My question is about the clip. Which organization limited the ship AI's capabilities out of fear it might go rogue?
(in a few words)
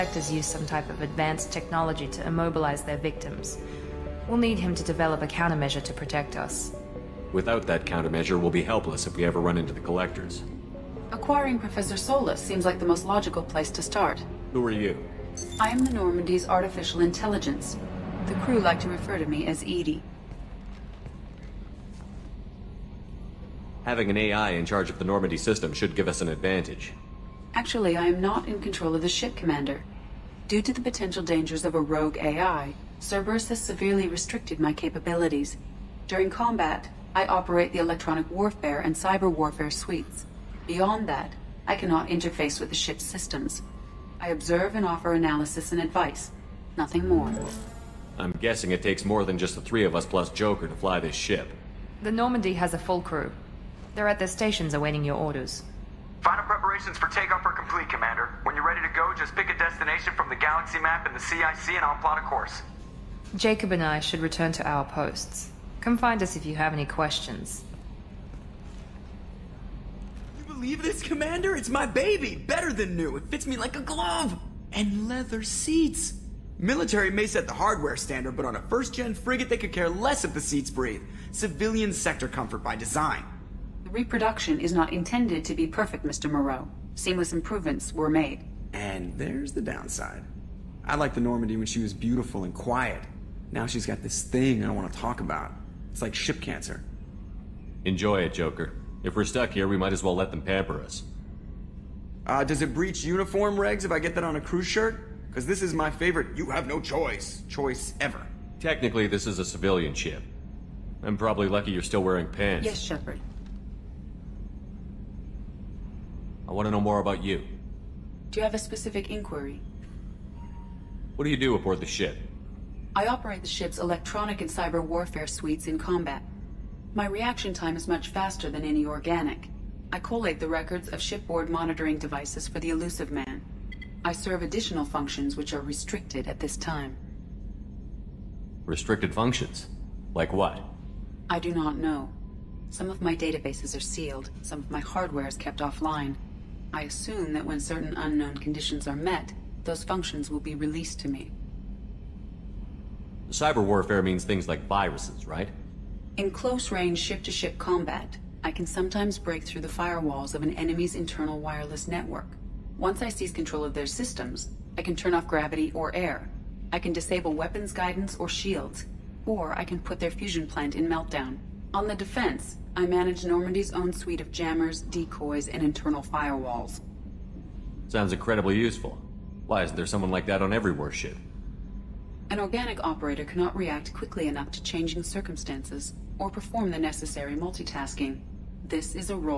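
Cerberus.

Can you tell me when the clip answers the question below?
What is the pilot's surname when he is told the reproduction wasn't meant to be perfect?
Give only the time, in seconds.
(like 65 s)
86 s.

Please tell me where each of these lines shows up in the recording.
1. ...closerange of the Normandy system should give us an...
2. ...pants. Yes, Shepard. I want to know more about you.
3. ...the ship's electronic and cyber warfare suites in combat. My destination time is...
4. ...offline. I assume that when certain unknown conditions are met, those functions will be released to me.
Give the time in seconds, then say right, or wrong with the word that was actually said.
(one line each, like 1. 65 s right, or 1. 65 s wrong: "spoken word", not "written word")
1. 24 s wrong: "charge", not "closerange"
2. 112 s right
3. 123 s wrong: "reaction", not "destination"
4. 145 s right.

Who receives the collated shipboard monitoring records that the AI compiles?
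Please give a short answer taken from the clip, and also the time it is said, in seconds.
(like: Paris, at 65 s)
The Illusive Man, at 132 s.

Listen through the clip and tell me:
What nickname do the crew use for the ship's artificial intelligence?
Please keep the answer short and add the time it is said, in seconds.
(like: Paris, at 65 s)
Edie, at 19 s.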